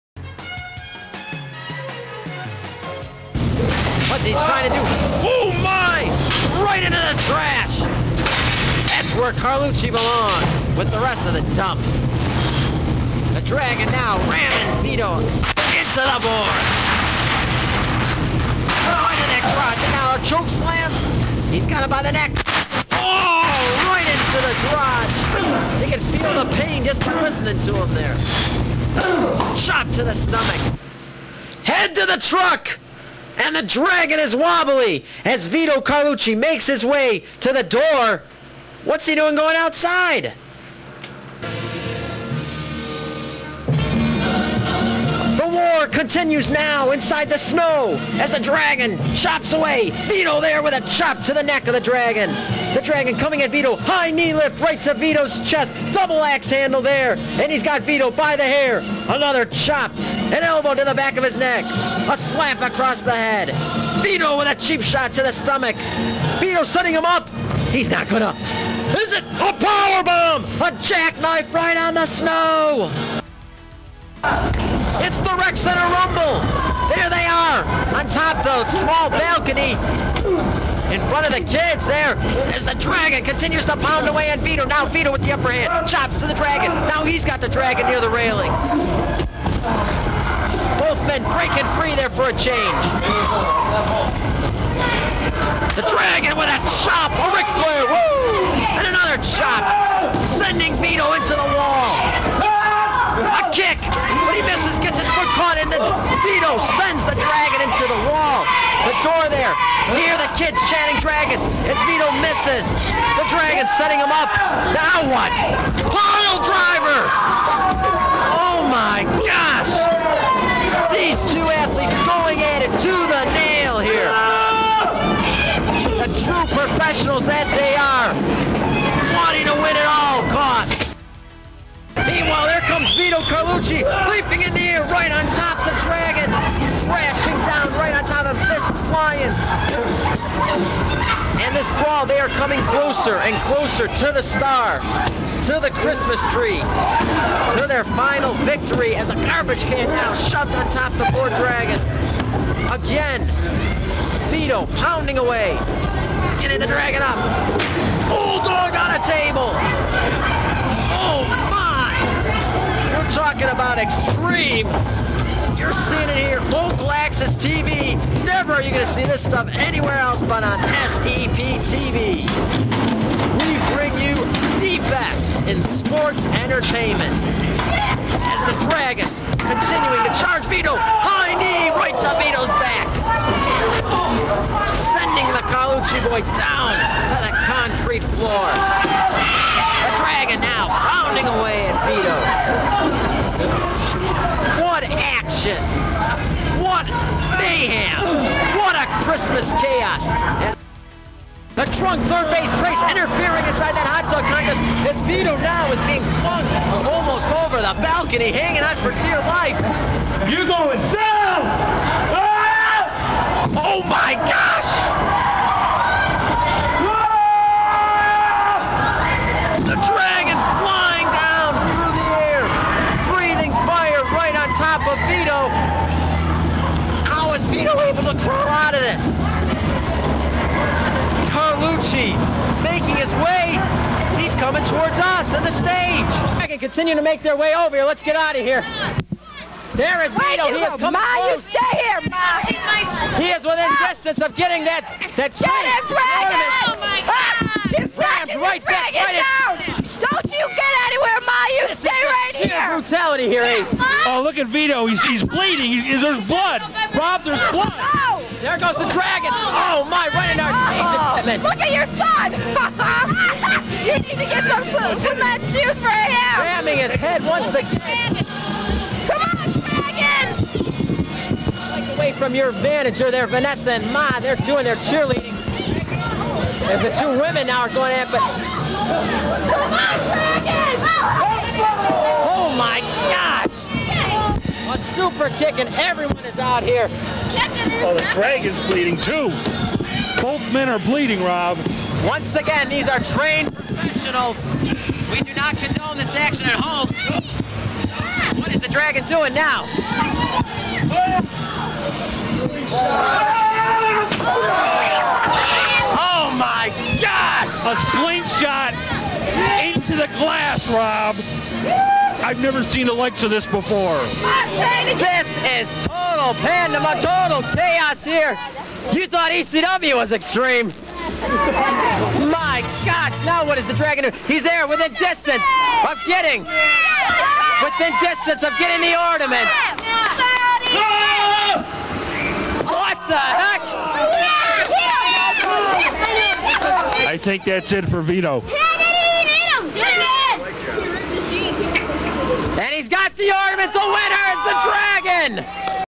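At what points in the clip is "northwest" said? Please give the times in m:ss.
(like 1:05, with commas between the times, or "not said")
not said.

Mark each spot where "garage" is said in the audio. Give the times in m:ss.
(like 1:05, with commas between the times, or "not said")
0:19, 0:24.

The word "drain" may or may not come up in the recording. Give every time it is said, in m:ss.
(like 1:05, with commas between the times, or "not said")
not said.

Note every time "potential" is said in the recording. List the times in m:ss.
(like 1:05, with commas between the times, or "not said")
not said.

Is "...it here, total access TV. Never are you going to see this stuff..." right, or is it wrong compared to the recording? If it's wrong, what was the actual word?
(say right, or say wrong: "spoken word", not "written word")
wrong: "local", not "total".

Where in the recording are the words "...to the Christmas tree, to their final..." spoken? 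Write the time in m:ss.
2:25.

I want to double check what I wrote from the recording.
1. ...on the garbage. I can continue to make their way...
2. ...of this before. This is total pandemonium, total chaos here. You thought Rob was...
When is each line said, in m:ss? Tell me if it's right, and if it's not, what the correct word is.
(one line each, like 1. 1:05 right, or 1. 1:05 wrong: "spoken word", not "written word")
1. 3:55 wrong: "stage", not "garbage"
2. 5:13 wrong: "ECW", not "Rob".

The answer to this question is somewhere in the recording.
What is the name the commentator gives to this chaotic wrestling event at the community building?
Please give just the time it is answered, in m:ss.
1:15.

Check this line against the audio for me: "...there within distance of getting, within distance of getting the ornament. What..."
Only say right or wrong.
right.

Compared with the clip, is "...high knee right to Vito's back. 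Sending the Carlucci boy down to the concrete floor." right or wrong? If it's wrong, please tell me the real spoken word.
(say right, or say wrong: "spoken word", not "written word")
right.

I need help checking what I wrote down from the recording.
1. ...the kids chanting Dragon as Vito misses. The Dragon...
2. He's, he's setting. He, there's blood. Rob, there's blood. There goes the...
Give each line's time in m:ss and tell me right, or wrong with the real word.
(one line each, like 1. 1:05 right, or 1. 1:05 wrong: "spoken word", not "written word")
1. 1:50 right
2. 4:14 wrong: "bleeding", not "setting".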